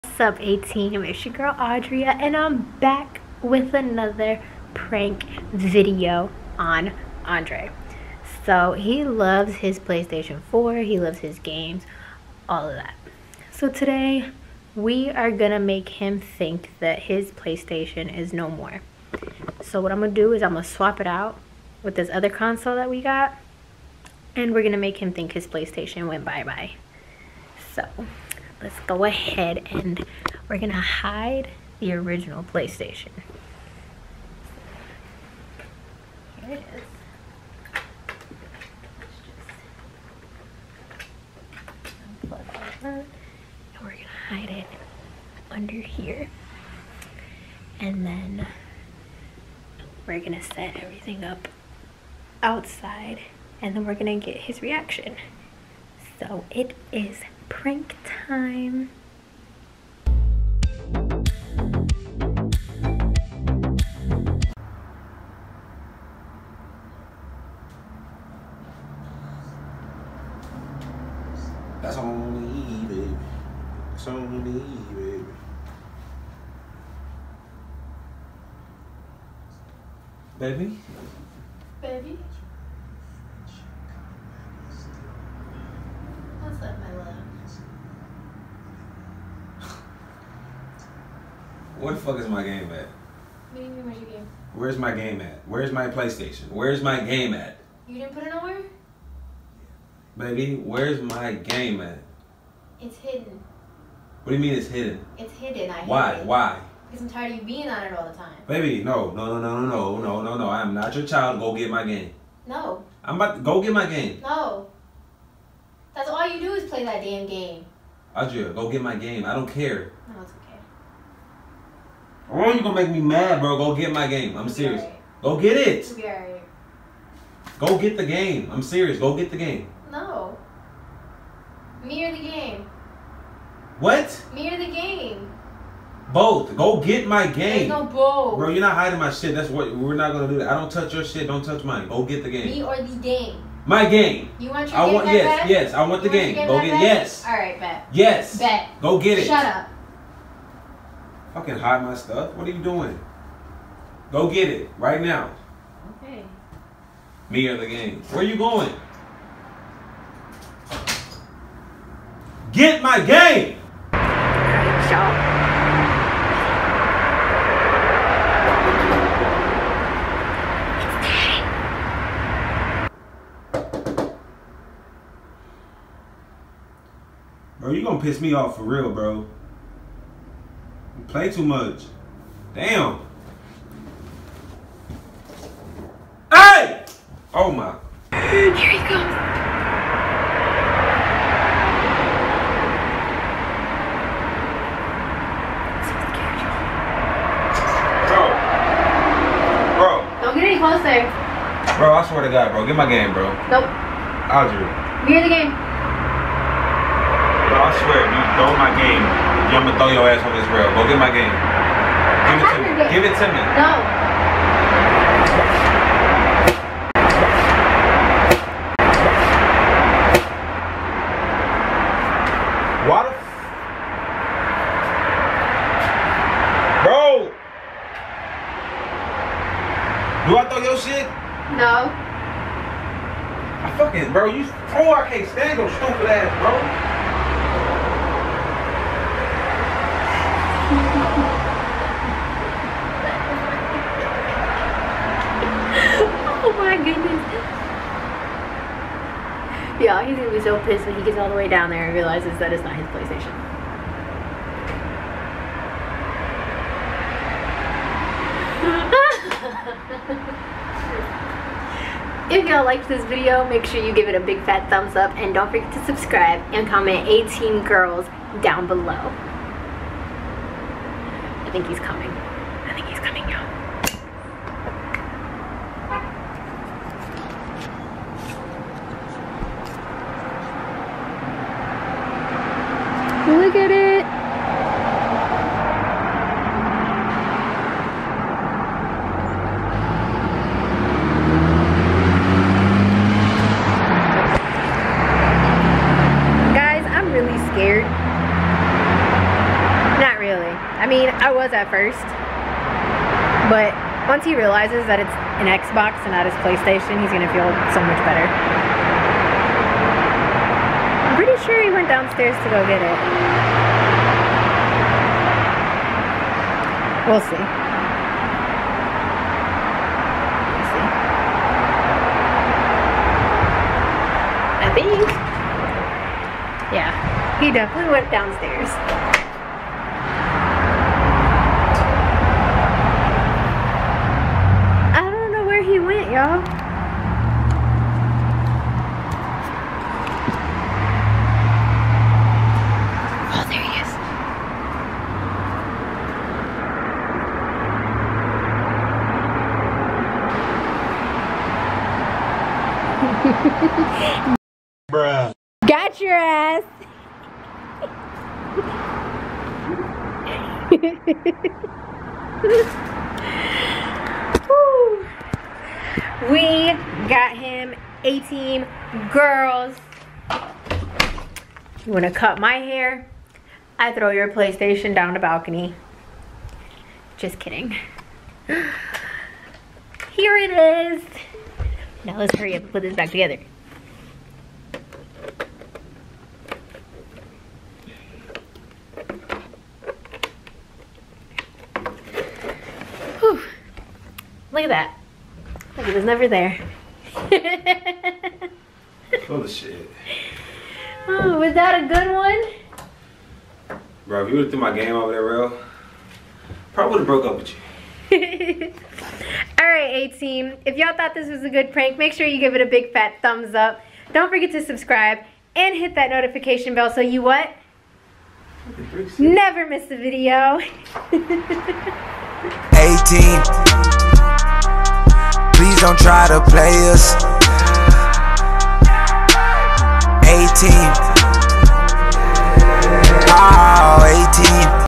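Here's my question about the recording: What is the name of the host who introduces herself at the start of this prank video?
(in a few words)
Audria.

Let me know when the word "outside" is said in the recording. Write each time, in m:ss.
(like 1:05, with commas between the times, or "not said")
0:52.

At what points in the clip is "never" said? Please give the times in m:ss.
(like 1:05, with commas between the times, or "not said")
6:36, 6:59.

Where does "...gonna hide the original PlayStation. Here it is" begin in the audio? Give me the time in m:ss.
0:30.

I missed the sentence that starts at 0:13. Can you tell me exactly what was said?
So, today we are gonna make him think that his PlayStation is no more.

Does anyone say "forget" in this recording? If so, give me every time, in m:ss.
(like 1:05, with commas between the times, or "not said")
4:25, 6:54.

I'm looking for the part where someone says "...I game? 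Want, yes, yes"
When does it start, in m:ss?
2:24.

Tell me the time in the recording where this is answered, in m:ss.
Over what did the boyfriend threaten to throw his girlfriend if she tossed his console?
3:30.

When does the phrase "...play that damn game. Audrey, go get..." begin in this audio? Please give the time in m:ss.
1:56.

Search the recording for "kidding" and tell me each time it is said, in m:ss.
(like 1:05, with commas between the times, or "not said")
6:17.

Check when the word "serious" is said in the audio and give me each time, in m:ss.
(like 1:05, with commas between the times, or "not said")
2:04, 2:08.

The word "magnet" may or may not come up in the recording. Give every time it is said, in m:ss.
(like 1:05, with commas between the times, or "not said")
not said.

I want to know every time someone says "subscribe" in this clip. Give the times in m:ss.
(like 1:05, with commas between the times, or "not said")
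4:25, 6:54.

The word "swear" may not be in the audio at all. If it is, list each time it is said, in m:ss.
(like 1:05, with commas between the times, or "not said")
3:22, 3:27.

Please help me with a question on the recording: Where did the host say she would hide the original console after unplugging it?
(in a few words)
under here.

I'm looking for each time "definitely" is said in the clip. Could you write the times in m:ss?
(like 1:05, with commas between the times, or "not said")
5:27.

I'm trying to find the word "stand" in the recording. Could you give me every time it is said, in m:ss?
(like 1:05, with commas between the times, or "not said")
3:55.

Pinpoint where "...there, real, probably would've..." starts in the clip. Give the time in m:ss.
6:45.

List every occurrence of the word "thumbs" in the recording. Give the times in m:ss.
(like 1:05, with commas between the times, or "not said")
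4:24, 6:53.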